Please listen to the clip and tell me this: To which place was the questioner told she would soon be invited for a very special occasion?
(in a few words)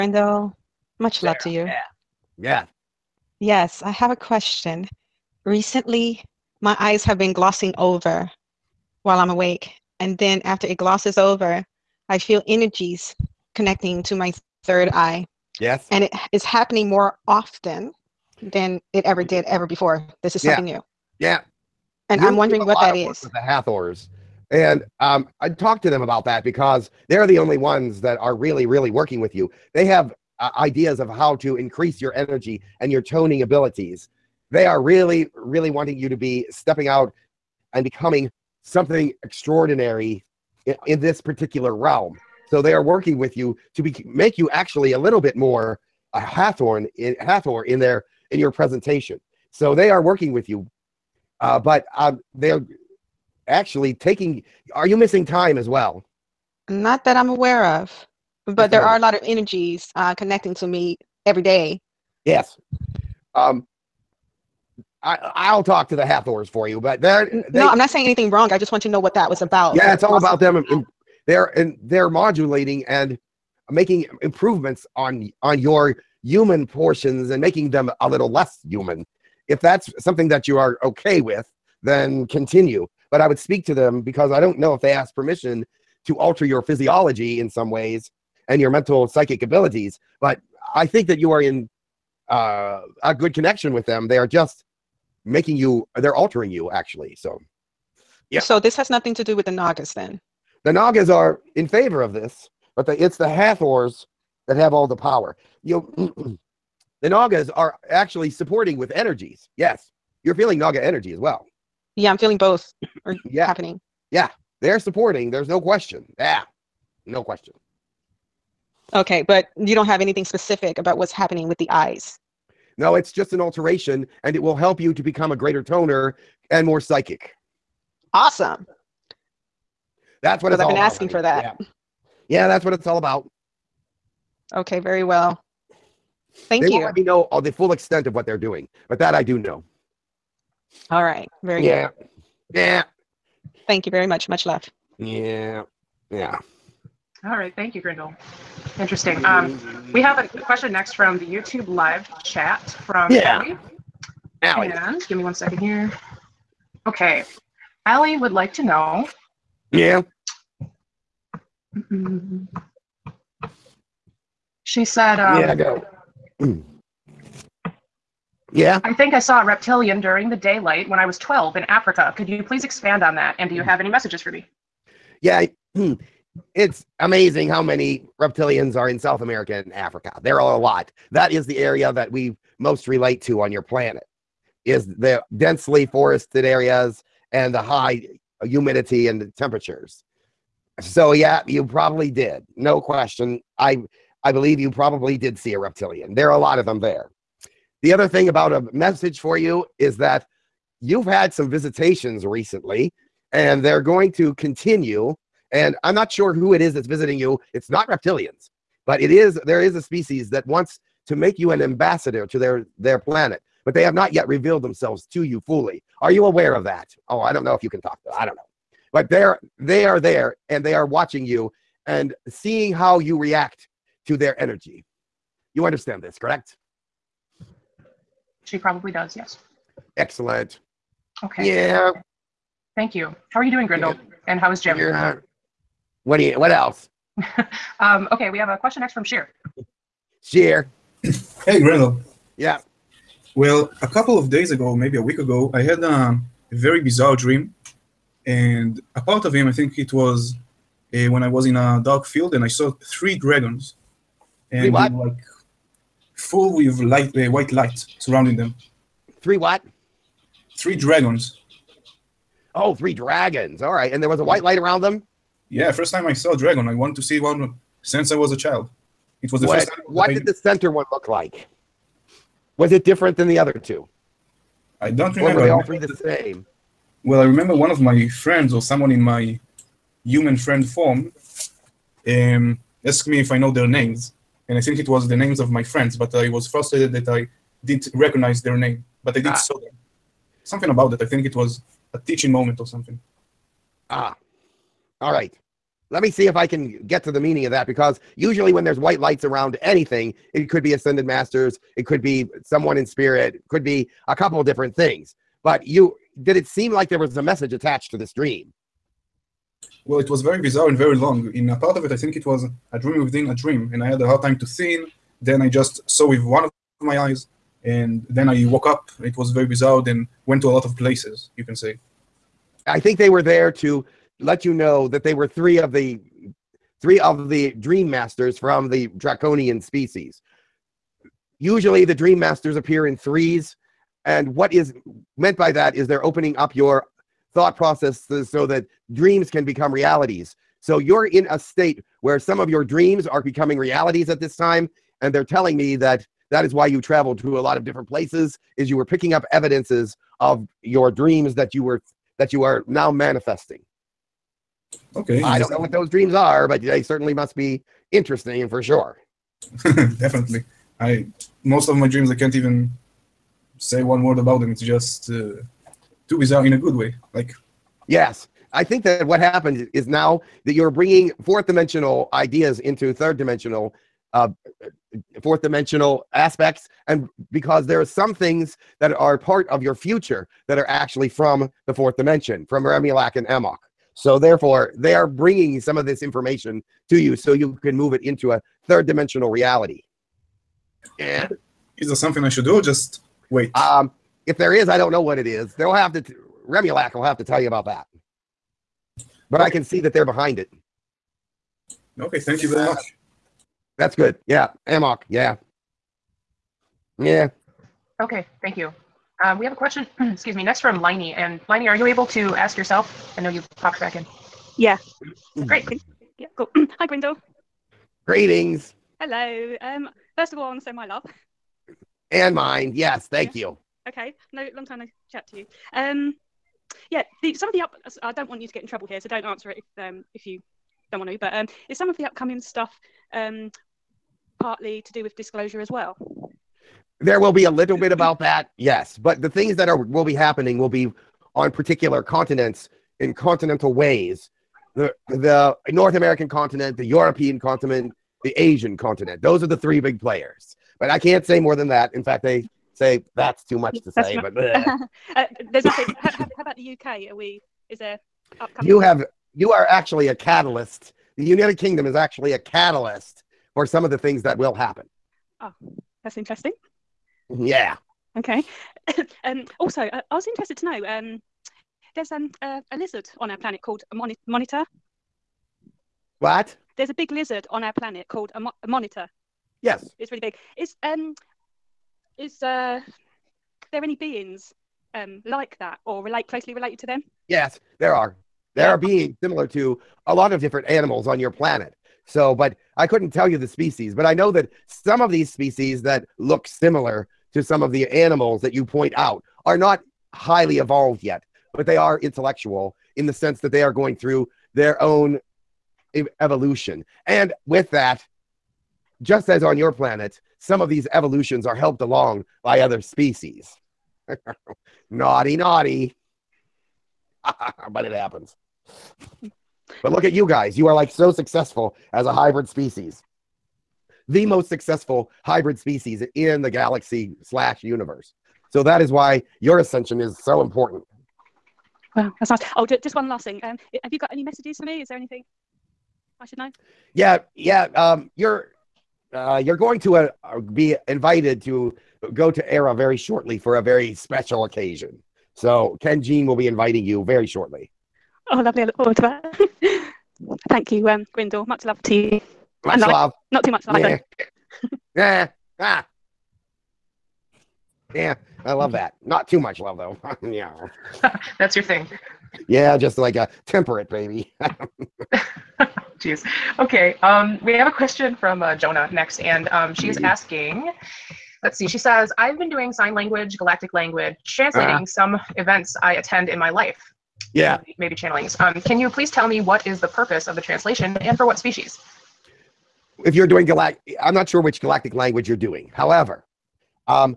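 Erra.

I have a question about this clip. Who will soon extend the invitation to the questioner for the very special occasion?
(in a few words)
Ken Jean.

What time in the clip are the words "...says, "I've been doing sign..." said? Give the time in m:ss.
9:31.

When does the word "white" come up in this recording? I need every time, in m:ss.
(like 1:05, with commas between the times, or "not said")
4:17, 4:24, 4:58.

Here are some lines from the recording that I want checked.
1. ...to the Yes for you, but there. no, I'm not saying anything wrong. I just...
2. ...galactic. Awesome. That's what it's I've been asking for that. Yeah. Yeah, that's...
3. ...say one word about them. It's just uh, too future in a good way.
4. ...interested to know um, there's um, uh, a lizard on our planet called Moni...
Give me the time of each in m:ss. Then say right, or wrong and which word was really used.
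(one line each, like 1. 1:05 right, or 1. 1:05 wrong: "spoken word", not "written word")
1. 1:05 wrong: "Hathors", not "Yes"
2. 2:06 wrong: "psychic", not "galactic"
3. 6:03 wrong: "bizarre", not "future"
4. 7:50 right.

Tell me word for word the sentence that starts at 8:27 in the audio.
And with that, just as on your planet, some of these evolutions are helped along by other species.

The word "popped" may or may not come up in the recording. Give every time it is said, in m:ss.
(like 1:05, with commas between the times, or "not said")
6:53.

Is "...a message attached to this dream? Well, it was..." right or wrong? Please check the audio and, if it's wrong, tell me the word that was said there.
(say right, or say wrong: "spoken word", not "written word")
right.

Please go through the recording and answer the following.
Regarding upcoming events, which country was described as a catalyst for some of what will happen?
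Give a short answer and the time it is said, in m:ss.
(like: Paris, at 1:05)
United Kingdom, at 7:41.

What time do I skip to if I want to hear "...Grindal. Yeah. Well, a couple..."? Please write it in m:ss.
4:01.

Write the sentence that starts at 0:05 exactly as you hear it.
Recently, my eyes have been glossing over while I'm awake.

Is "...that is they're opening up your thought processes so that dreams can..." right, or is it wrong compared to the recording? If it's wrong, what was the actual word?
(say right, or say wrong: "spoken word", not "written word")
right.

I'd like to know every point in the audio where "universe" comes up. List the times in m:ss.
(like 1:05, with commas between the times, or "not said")
8:47.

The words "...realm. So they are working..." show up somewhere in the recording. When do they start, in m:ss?
0:41.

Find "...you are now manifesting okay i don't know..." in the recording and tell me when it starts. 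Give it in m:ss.
5:52.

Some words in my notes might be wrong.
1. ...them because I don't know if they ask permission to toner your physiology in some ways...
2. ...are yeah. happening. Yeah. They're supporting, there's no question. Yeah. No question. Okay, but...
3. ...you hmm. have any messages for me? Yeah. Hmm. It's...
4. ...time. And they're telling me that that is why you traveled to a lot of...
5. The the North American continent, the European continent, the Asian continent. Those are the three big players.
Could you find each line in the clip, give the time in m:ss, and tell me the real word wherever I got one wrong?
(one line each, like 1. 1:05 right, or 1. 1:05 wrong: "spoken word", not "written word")
1. 1:23 wrong: "alter", not "toner"
2. 1:53 right
3. 2:53 right
4. 5:44 right
5. 7:24 right.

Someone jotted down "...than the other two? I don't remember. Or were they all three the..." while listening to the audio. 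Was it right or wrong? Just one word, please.
right.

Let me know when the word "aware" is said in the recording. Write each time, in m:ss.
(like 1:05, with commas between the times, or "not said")
0:57, 3:36.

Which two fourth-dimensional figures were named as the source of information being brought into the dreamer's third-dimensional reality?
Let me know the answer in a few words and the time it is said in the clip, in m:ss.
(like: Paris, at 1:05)
Remulak and Amok, at 6:22.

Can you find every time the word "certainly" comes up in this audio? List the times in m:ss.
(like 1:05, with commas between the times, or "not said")
5:56.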